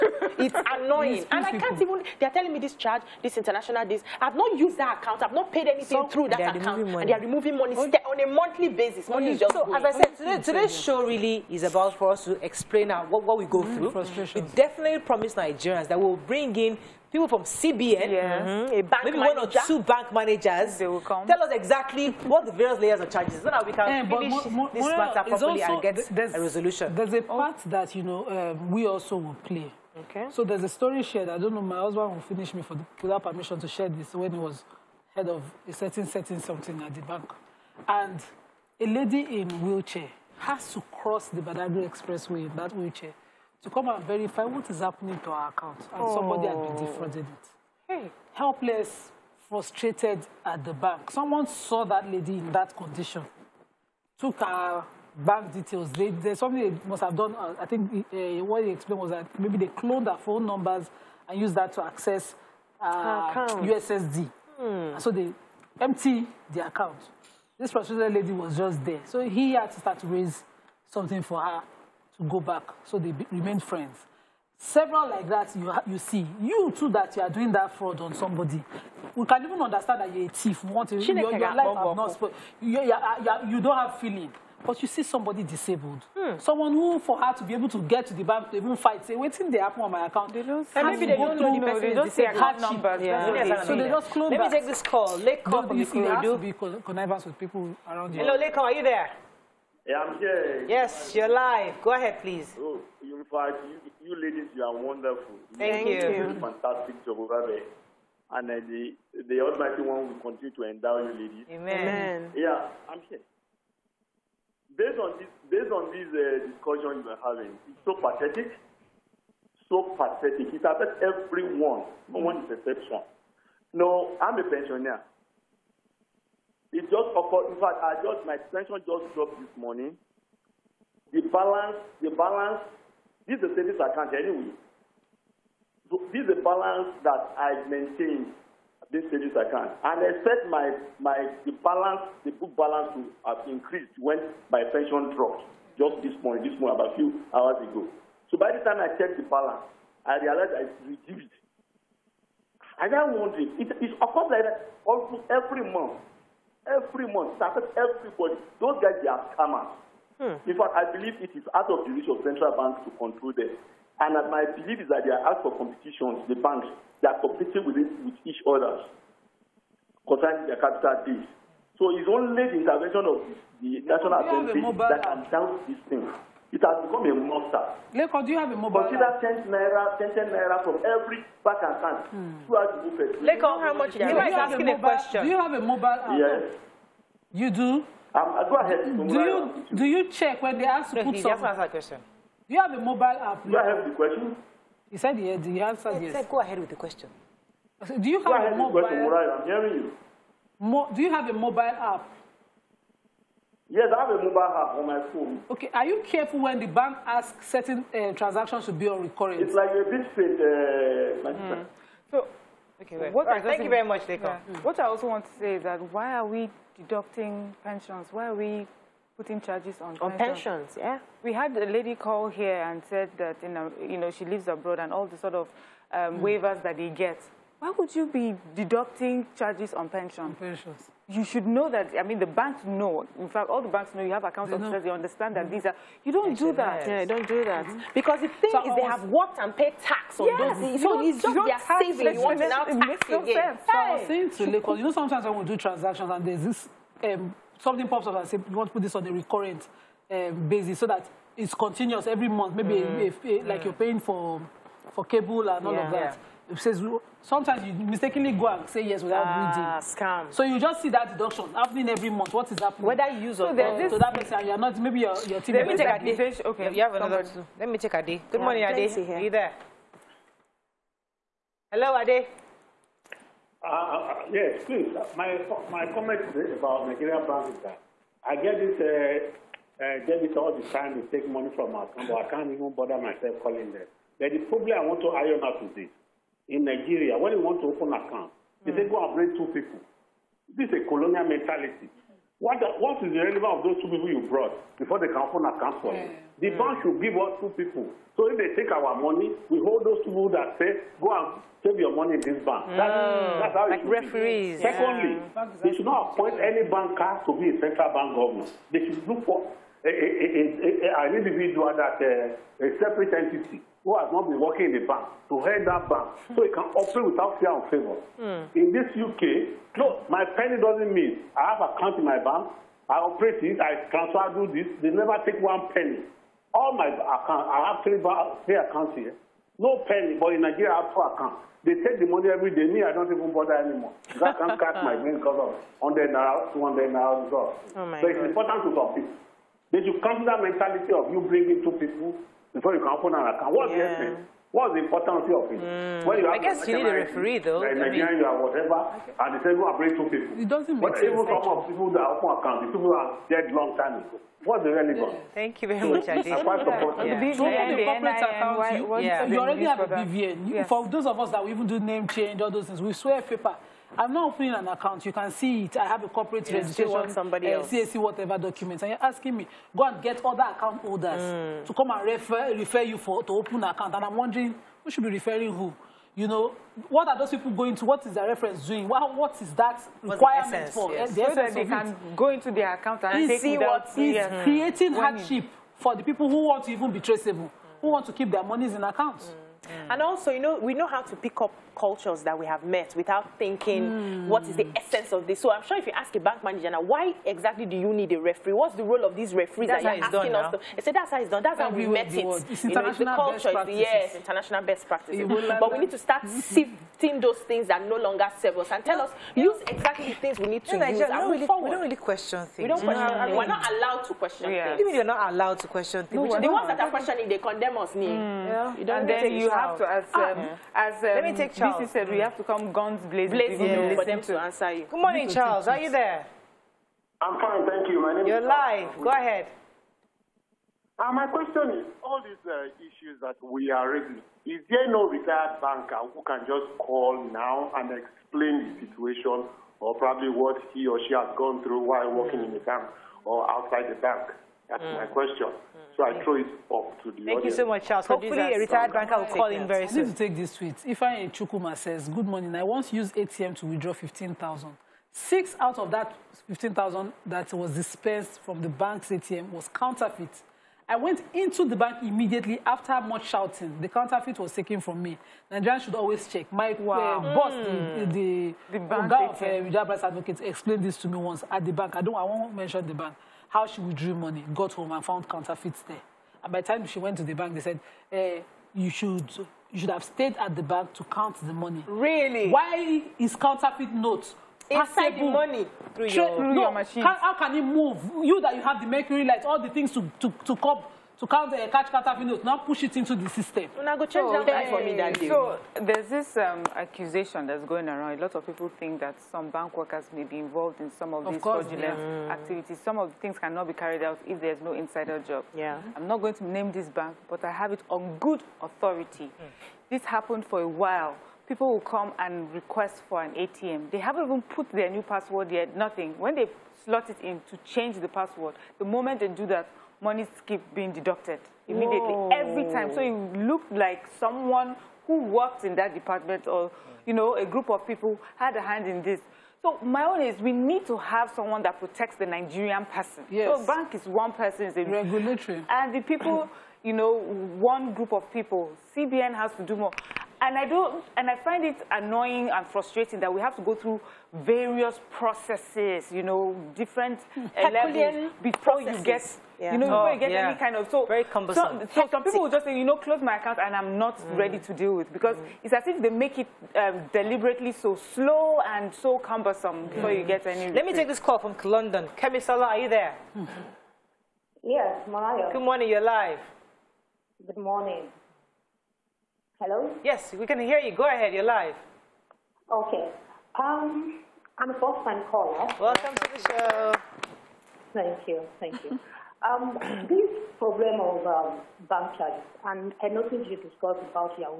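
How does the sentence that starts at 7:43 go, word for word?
The counterfeit was taken from me.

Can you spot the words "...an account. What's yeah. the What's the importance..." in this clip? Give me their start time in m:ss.
5:43.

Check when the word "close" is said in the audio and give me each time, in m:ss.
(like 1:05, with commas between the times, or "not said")
1:34, 9:12.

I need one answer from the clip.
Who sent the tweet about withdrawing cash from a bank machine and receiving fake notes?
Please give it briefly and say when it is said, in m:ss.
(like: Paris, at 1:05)
Chukwuma, at 7:31.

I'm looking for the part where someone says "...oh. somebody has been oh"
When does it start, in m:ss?
0:46.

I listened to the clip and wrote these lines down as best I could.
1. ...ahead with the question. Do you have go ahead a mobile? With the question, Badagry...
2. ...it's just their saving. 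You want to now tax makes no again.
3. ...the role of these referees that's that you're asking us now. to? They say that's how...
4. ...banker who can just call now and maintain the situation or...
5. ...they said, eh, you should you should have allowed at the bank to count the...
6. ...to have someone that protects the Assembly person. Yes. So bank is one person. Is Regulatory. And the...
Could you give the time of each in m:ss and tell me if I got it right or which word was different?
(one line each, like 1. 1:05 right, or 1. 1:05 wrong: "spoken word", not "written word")
1. 3:16 wrong: "Murai", not "Badagry"
2. 4:01 right
3. 6:38 right
4. 7:15 wrong: "explain", not "maintain"
5. 7:57 wrong: "stayed", not "allowed"
6. 8:50 wrong: "Nigerian", not "Assembly".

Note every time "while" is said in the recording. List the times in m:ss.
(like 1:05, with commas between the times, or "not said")
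7:21, 8:30.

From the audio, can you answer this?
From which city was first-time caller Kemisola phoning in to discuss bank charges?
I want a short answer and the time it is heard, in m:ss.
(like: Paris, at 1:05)
London, at 9:21.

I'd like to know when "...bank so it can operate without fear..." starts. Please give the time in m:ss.
5:15.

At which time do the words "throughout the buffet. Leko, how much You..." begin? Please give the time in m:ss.
3:02.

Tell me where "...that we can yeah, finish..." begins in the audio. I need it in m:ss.
0:23.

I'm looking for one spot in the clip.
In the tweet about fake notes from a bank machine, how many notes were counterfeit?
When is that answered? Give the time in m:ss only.
7:35.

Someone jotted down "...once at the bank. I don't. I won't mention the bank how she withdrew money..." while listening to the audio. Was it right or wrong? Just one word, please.
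right.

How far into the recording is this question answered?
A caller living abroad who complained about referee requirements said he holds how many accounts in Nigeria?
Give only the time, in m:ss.
5:30.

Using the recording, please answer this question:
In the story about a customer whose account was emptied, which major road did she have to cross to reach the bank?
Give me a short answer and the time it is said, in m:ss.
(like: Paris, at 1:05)
Badagry Expressway, at 0:41.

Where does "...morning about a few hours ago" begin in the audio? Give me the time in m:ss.
2:26.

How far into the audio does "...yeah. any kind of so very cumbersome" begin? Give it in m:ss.
9:10.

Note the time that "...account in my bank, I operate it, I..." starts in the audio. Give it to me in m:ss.
5:21.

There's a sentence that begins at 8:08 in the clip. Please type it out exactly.
You that you have the mercury lights, all the things to, to, to cope?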